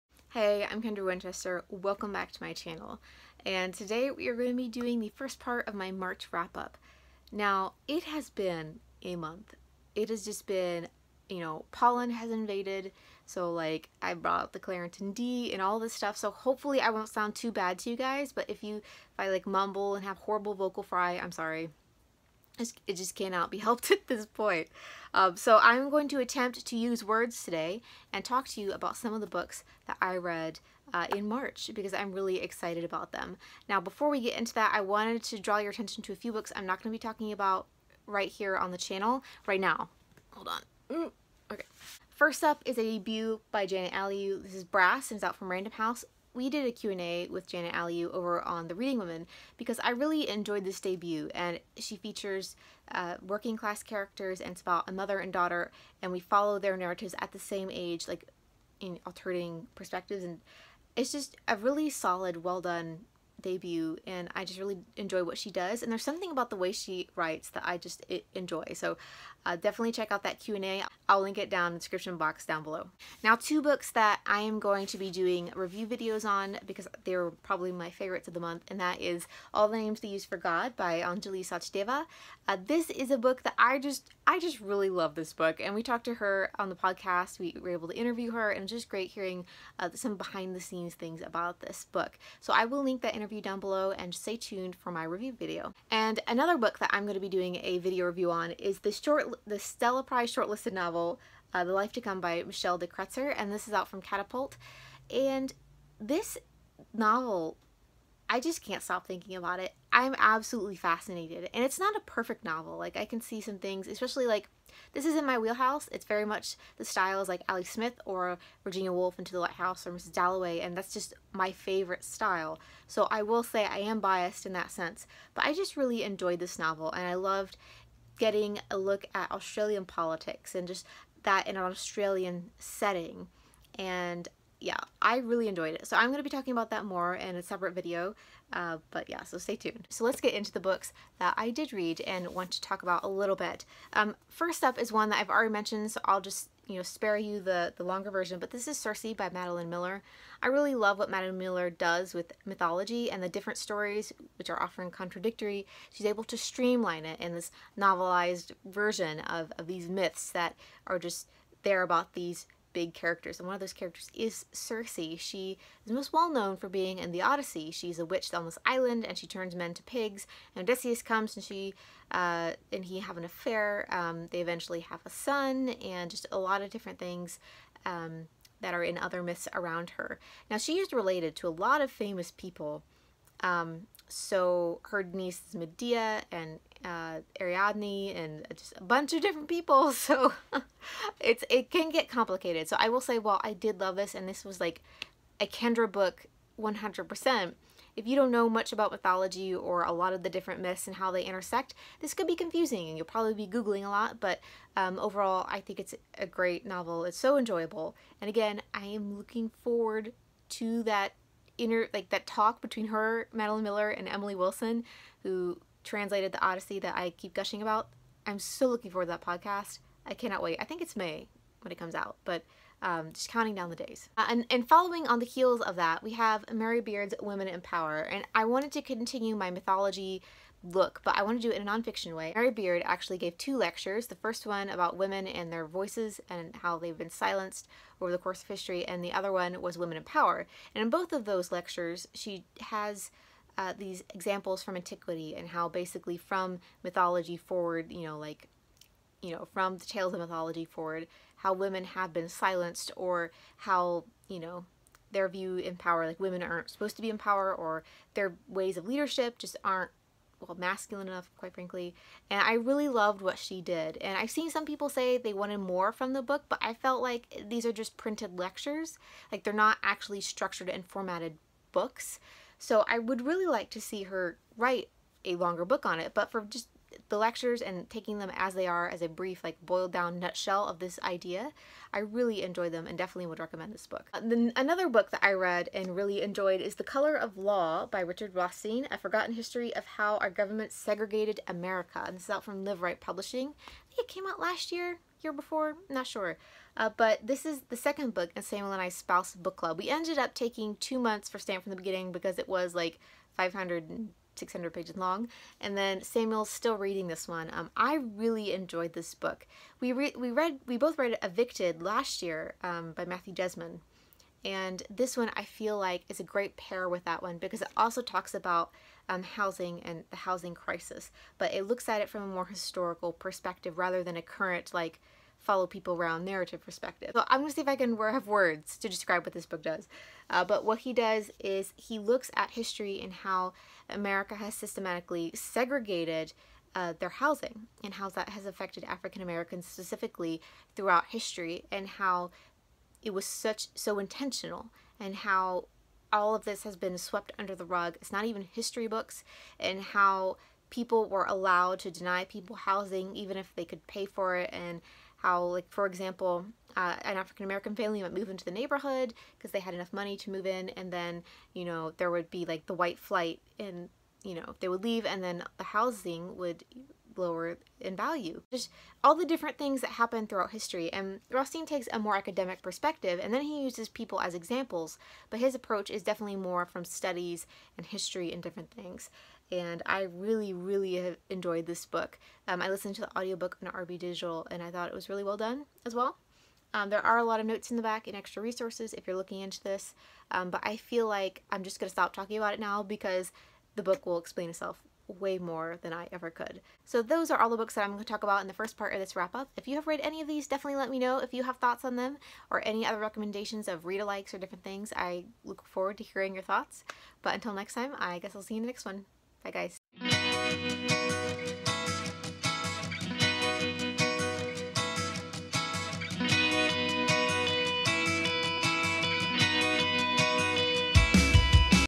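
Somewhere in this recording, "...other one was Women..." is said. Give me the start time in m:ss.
3:59.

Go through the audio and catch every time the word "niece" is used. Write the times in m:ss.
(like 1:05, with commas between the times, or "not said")
3:05.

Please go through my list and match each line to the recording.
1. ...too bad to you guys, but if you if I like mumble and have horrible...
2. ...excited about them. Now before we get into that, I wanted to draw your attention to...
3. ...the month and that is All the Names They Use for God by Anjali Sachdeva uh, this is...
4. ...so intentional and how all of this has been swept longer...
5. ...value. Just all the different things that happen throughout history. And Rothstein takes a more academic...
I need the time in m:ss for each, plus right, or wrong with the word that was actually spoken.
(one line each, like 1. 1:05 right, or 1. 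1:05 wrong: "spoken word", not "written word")
1. 0:17 right
2. 0:32 right
3. 1:18 right
4. 5:43 wrong: "under", not "longer"
5. 6:07 right.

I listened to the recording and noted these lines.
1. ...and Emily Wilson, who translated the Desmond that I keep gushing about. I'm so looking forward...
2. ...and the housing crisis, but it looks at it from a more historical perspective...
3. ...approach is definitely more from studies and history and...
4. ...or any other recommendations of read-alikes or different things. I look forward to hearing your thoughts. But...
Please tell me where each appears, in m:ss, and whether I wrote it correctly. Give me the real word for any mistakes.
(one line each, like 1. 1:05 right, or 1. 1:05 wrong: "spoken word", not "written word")
1. 3:33 wrong: "Odyssey", not "Desmond"
2. 5:19 right
3. 6:15 right
4. 6:42 right.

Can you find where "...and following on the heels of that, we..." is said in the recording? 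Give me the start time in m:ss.
3:44.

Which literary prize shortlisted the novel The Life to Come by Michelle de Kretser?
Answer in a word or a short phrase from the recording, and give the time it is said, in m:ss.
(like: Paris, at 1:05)
Stella Prize, at 1:39.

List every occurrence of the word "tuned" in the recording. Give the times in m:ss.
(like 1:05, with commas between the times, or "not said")
1:34, 2:19.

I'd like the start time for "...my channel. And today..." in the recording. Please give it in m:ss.
0:02.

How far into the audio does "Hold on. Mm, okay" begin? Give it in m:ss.
0:40.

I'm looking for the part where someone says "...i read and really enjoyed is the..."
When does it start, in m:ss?
4:45.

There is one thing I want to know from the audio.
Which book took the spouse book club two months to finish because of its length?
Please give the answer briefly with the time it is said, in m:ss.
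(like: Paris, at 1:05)
Stamp from the Beginning, at 5:01.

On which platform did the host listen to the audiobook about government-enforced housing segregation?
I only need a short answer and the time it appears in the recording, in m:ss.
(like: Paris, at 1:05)
RB Digital, at 6:23.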